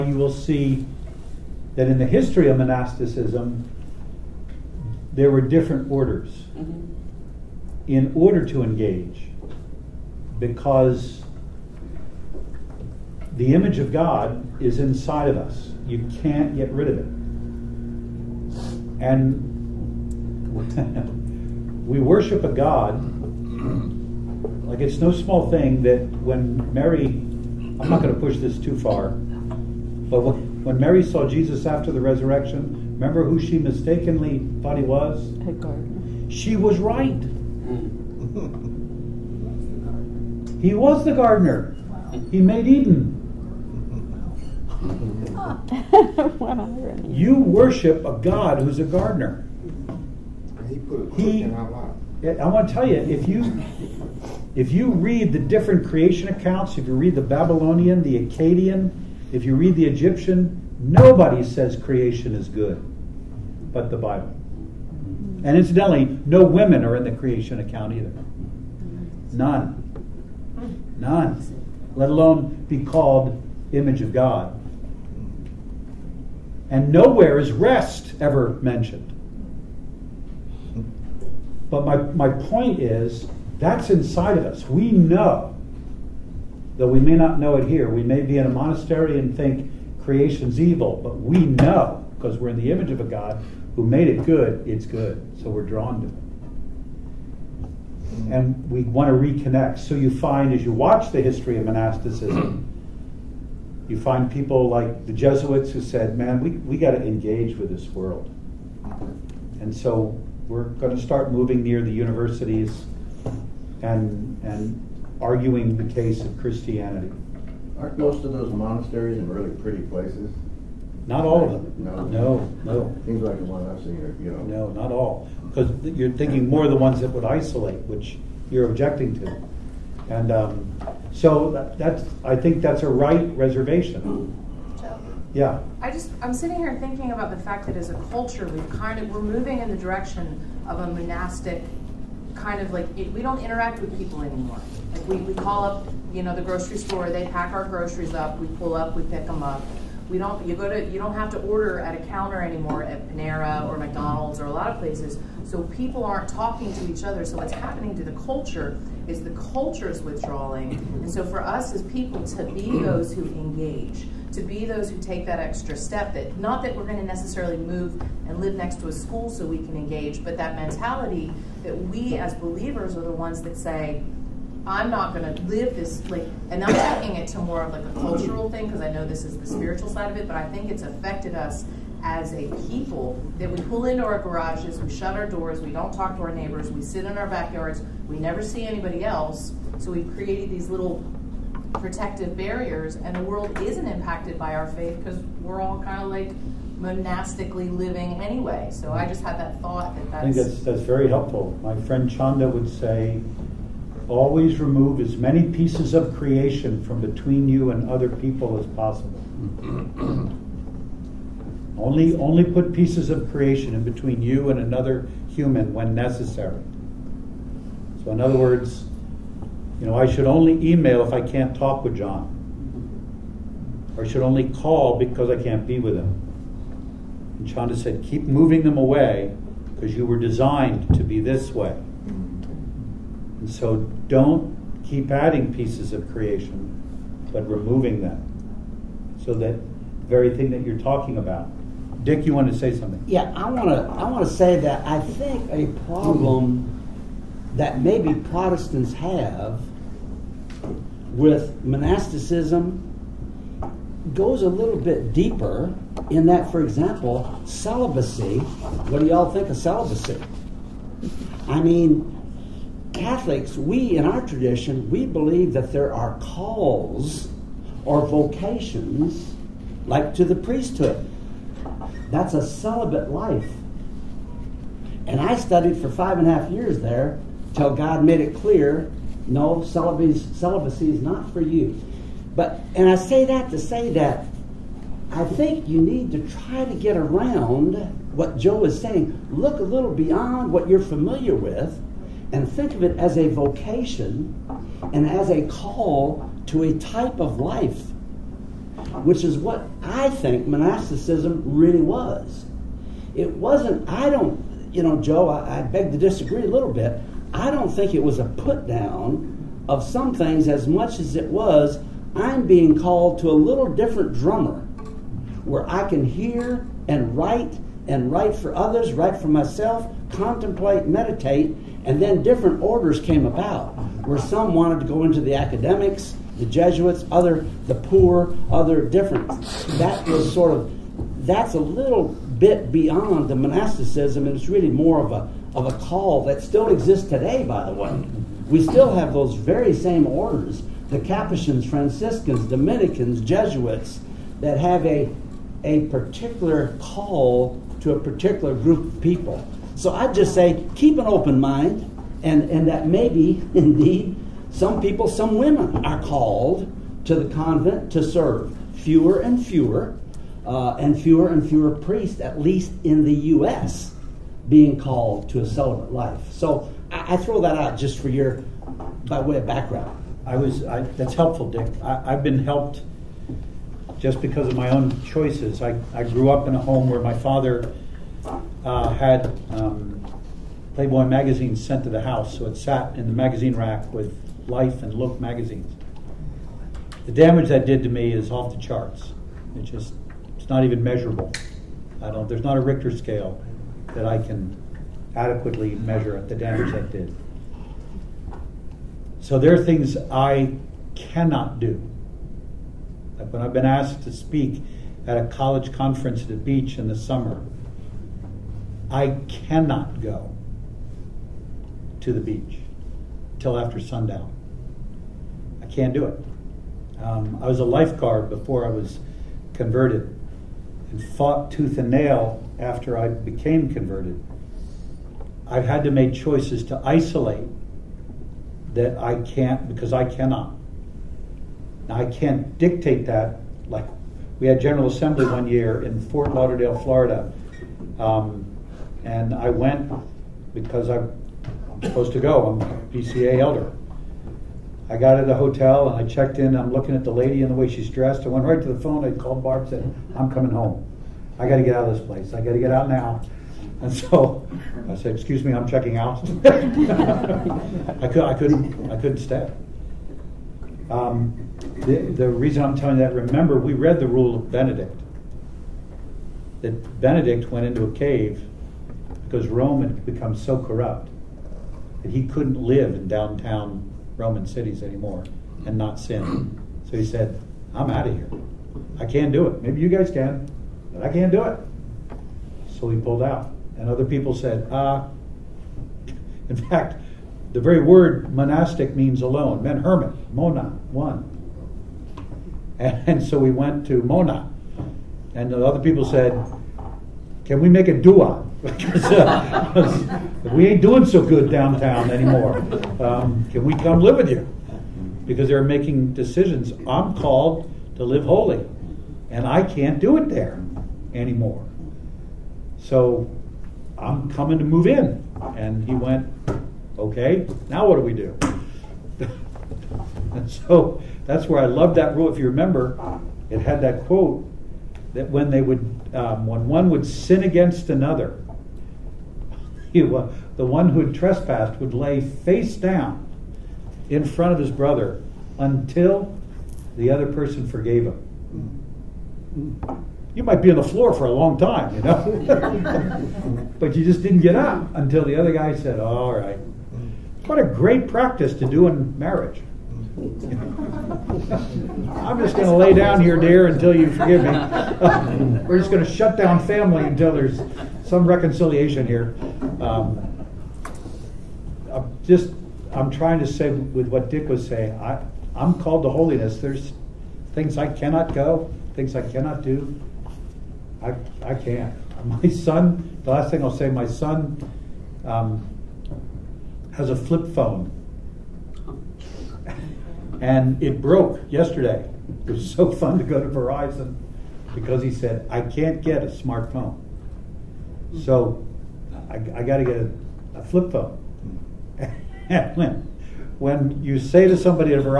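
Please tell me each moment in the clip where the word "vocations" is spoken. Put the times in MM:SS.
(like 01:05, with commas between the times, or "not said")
04:28, 04:53.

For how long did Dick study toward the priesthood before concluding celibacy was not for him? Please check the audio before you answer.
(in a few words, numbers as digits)
5.5 years.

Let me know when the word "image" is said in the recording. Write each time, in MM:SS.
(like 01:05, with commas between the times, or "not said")
00:13, 01:13, 01:32.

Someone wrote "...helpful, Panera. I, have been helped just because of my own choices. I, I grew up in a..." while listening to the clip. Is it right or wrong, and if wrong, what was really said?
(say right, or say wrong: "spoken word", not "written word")
wrong: "Dick", not "Panera".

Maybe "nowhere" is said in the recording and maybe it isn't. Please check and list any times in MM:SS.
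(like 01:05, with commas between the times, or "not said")
01:16.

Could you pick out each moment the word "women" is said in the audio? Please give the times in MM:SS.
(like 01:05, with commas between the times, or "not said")
01:06, 05:55.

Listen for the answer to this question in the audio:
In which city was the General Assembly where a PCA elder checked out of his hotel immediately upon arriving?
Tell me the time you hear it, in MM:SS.
07:16.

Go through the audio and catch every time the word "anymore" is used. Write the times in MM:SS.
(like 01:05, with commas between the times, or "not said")
02:24, 02:32, 07:54, 08:22, 08:31.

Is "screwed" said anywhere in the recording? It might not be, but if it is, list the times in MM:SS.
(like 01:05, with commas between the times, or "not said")
not said.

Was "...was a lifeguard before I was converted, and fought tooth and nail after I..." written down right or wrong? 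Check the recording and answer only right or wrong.
right.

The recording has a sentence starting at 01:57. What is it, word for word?
Aren't most of those monasteries really pretty places?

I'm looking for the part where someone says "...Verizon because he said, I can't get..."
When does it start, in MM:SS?
09:43.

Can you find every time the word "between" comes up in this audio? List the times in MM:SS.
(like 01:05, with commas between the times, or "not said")
03:27, 03:33.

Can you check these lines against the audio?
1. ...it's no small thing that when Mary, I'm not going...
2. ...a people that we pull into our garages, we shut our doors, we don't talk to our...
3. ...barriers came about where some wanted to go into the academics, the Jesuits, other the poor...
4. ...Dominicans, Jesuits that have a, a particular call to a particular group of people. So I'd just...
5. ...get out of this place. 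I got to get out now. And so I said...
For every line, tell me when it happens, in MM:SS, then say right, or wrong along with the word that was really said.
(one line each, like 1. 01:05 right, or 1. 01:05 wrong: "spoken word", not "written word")
1. 00:24 right
2. 03:02 right
3. 05:22 wrong: "orders", not "barriers"
4. 05:42 right
5. 07:31 right.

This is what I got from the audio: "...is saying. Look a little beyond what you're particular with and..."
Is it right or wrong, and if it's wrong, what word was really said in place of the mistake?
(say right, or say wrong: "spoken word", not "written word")
wrong: "familiar", not "particular".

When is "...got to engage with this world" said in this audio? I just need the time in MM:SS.
01:46.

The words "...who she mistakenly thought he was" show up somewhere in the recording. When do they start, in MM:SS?
00:33.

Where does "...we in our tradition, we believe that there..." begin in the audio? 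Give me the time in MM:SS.
04:23.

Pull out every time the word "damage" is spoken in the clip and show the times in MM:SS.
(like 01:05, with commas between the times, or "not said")
06:27, 06:36.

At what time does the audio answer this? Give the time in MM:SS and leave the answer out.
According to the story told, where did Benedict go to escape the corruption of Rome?
07:47.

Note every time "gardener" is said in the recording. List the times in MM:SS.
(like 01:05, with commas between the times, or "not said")
00:41, 00:48.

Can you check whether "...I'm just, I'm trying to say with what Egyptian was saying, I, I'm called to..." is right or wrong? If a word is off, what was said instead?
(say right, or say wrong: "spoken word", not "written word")
wrong: "Dick", not "Egyptian".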